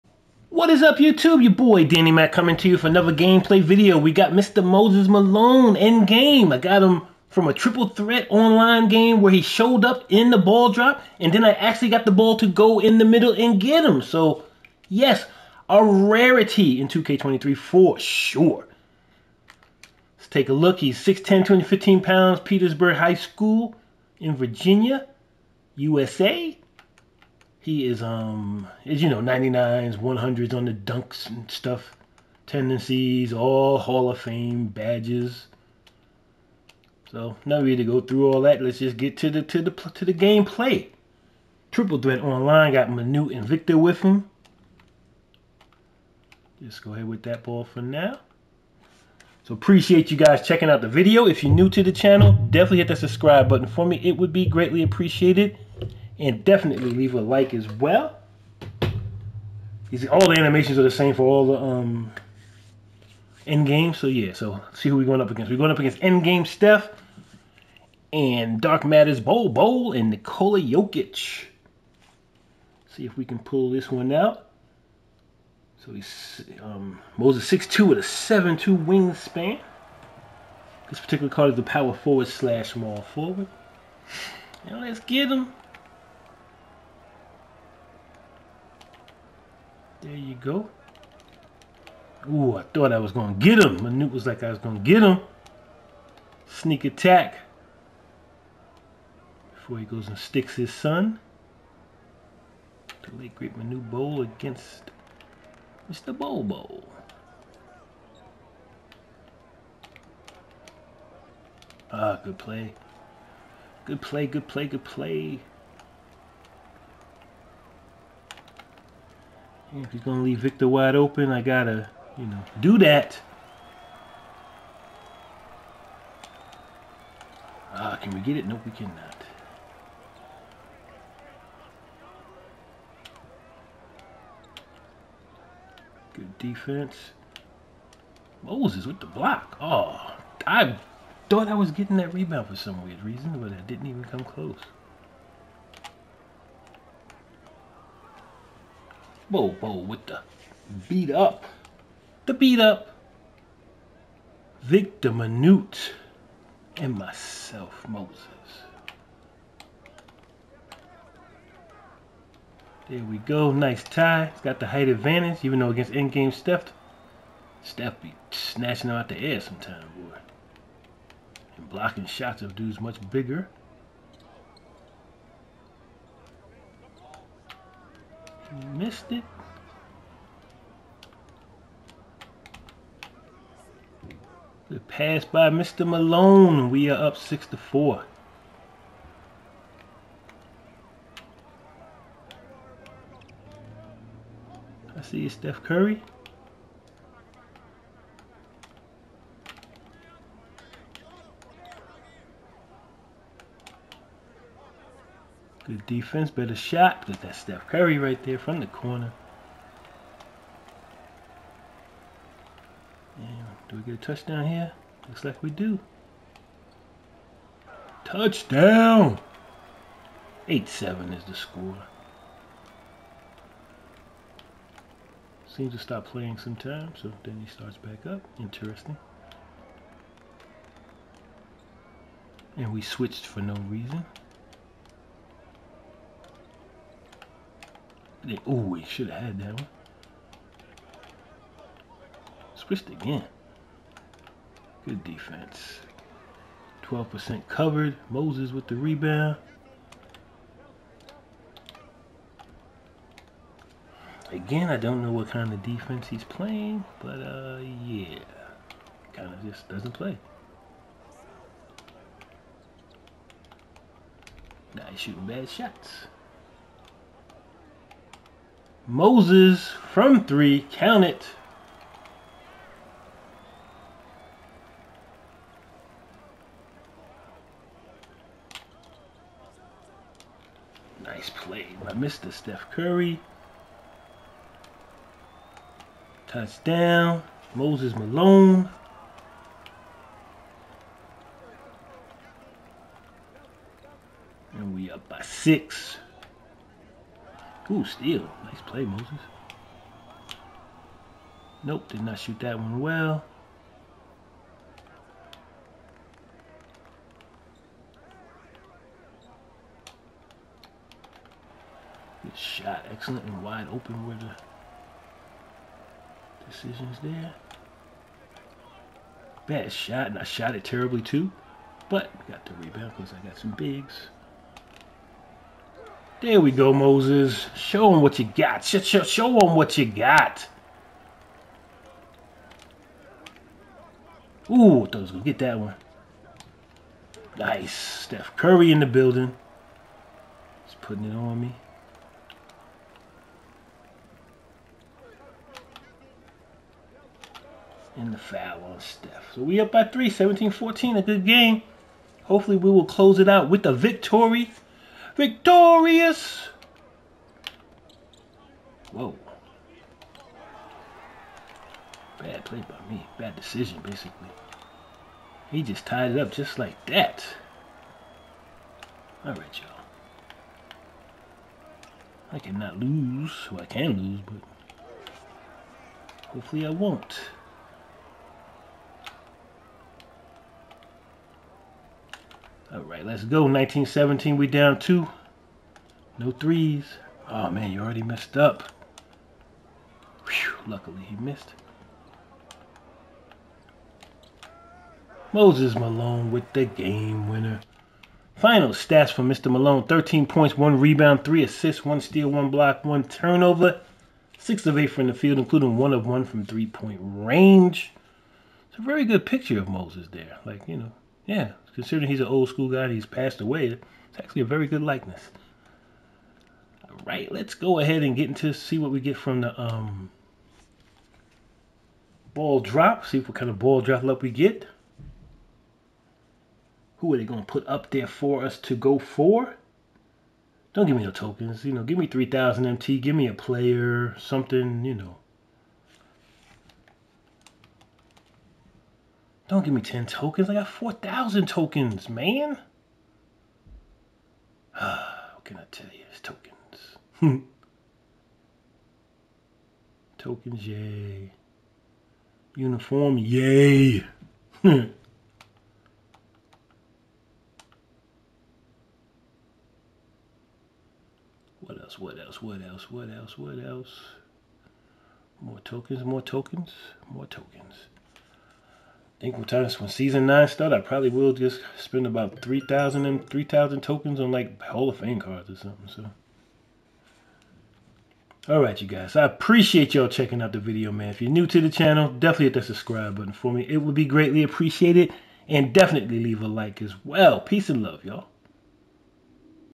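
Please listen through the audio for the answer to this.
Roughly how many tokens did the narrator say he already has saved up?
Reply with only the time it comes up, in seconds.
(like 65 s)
440 s.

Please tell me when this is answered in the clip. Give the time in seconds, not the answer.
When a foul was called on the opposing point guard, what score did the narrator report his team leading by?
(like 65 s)
350 s.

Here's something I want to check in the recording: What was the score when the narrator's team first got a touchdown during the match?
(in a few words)
8-7.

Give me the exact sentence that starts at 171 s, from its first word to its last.
And blocking shots of dudes much bigger.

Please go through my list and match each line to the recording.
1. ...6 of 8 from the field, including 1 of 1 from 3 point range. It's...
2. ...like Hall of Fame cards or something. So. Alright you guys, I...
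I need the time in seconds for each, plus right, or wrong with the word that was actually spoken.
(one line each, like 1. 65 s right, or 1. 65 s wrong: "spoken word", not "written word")
1. 404 s right
2. 474 s right.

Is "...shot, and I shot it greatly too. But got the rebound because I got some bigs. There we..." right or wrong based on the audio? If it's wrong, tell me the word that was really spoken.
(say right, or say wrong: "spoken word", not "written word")
wrong: "terribly", not "greatly".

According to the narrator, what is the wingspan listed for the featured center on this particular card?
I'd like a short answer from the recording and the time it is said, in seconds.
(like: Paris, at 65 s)
7'2", at 78 s.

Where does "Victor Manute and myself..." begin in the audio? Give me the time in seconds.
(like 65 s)
154 s.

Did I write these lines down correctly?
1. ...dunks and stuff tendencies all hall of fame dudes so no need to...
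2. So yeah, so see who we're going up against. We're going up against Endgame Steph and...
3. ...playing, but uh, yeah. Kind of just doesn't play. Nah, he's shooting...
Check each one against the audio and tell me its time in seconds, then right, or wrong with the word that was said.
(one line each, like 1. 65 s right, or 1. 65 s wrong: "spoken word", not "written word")
1. 30 s wrong: "badges", not "dudes"
2. 63 s right
3. 256 s right.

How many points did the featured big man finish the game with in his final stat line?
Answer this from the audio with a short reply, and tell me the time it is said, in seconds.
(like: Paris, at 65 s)
13, at 399 s.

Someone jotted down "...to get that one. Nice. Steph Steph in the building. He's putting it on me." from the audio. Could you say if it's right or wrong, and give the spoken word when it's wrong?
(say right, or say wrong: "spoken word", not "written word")
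wrong: "Curry", not "Steph".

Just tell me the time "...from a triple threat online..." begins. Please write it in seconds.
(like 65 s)
7 s.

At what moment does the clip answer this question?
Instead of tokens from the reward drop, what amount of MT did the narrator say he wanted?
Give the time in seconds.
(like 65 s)
432 s.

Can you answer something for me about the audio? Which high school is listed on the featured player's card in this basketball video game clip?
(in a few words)
Petersburg High School.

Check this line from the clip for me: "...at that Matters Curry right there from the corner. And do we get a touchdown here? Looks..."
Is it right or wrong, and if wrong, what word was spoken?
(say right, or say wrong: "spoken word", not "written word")
wrong: "Steph", not "Matters".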